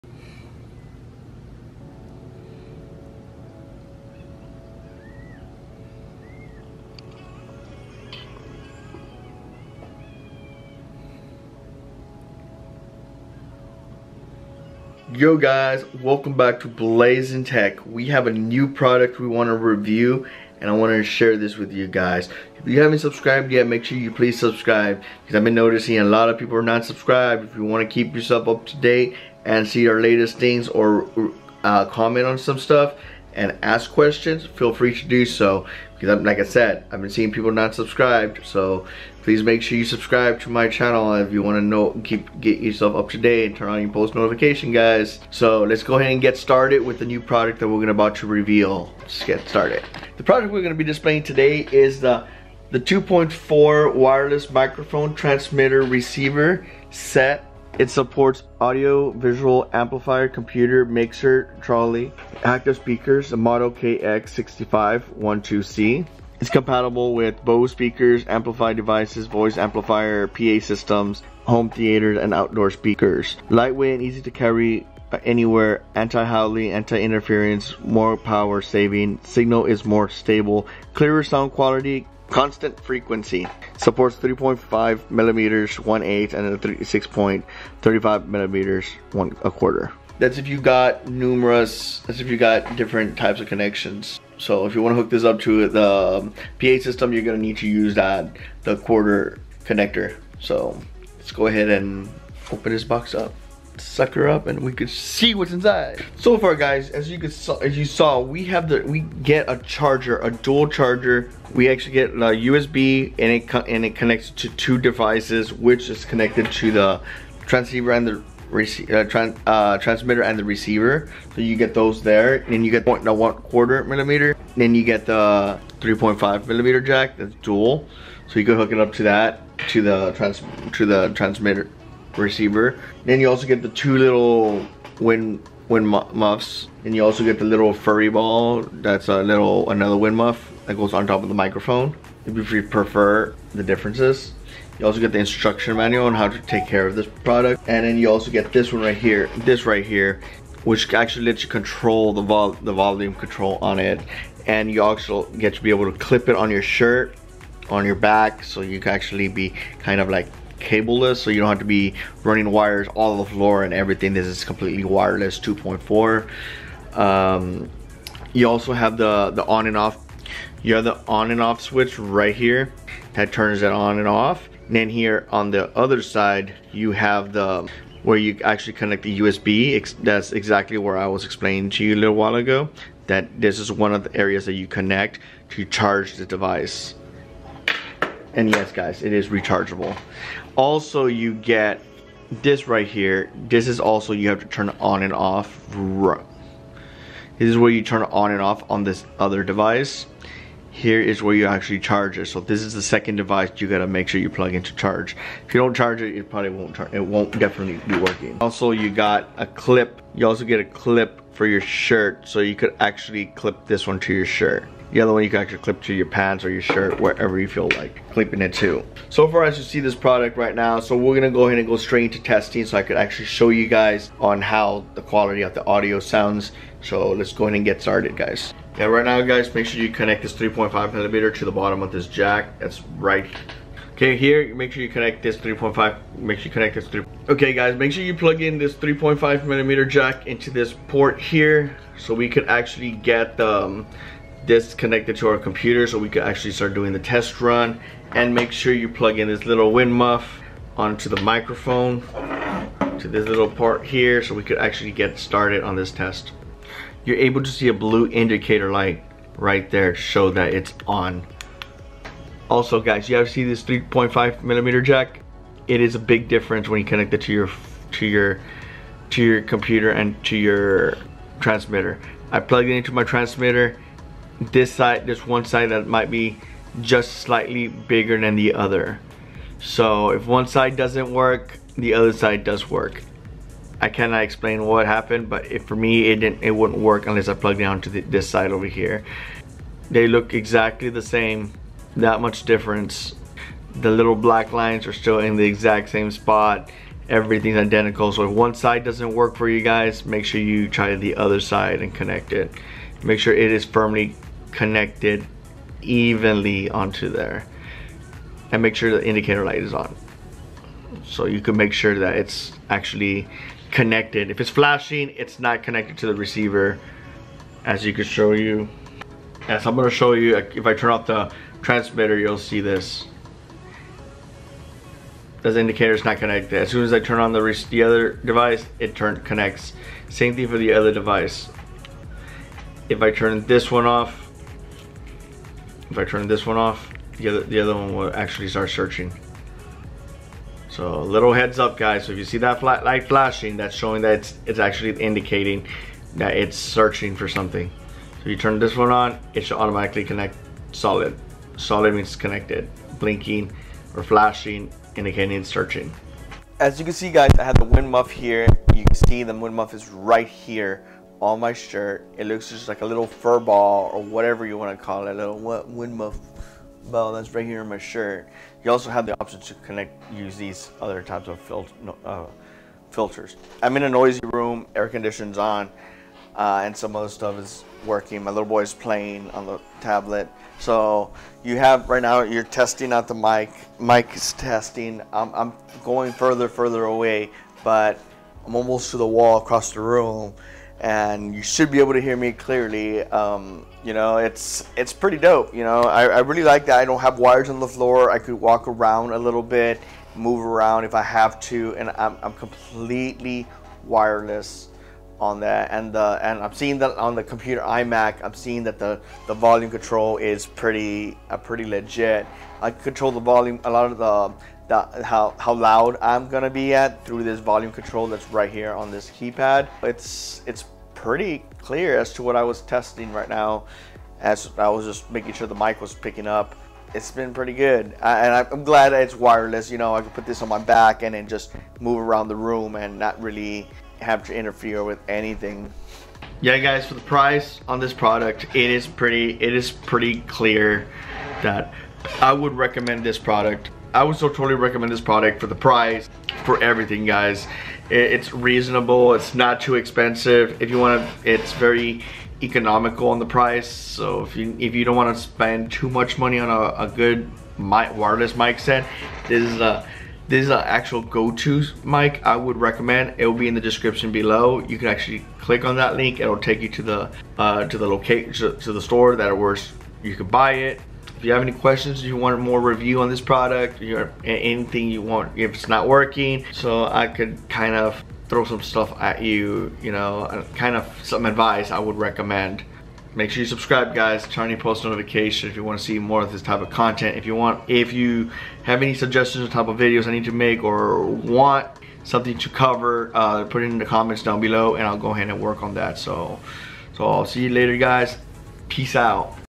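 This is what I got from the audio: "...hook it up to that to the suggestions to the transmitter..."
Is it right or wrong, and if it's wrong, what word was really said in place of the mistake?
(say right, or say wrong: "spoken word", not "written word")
wrong: "trans", not "suggestions".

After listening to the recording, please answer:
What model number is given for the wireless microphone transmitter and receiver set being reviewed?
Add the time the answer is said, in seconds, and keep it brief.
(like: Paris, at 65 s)
KX6512C, at 63 s.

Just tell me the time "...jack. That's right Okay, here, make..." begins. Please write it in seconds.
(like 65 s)
232 s.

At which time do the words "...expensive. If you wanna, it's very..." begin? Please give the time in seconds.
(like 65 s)
449 s.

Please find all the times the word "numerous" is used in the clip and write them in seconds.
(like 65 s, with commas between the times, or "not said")
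91 s.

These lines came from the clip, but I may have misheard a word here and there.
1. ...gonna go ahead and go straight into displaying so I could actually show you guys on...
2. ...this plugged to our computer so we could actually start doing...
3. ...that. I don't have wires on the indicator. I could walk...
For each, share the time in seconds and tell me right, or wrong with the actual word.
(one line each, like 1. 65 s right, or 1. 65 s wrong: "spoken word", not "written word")
1. 221 s wrong: "testing", not "displaying"
2. 244 s wrong: "connected", not "plugged"
3. 396 s wrong: "floor", not "indicator".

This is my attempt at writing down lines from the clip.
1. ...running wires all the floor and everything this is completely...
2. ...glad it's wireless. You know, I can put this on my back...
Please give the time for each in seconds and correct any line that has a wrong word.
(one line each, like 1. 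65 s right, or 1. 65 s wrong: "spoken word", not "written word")
1. 162 s right
2. 428 s right.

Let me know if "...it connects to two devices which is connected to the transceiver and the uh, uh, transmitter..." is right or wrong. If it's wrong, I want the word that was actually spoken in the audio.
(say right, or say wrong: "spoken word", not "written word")
right.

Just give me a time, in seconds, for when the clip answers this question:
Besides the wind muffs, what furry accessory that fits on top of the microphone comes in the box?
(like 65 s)
137 s.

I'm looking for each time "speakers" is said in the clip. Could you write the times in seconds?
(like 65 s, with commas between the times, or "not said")
62 s, 67 s, 72 s.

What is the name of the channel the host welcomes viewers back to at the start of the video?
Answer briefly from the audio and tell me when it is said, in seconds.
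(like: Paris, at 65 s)
Blazin' Tech, at 16 s.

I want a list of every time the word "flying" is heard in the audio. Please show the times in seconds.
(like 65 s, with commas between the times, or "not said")
not said.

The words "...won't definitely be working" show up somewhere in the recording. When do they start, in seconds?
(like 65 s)
207 s.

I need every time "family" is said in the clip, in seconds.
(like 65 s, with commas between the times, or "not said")
not said.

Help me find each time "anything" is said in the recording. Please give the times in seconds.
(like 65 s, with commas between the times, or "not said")
435 s, 474 s.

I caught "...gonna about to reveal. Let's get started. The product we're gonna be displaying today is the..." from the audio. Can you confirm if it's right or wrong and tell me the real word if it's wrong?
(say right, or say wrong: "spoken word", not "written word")
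right.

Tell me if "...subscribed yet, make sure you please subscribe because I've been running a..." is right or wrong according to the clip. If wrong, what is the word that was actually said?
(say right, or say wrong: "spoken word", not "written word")
wrong: "noticing", not "running".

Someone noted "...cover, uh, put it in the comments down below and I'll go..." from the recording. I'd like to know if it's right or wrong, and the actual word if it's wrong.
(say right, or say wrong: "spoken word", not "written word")
right.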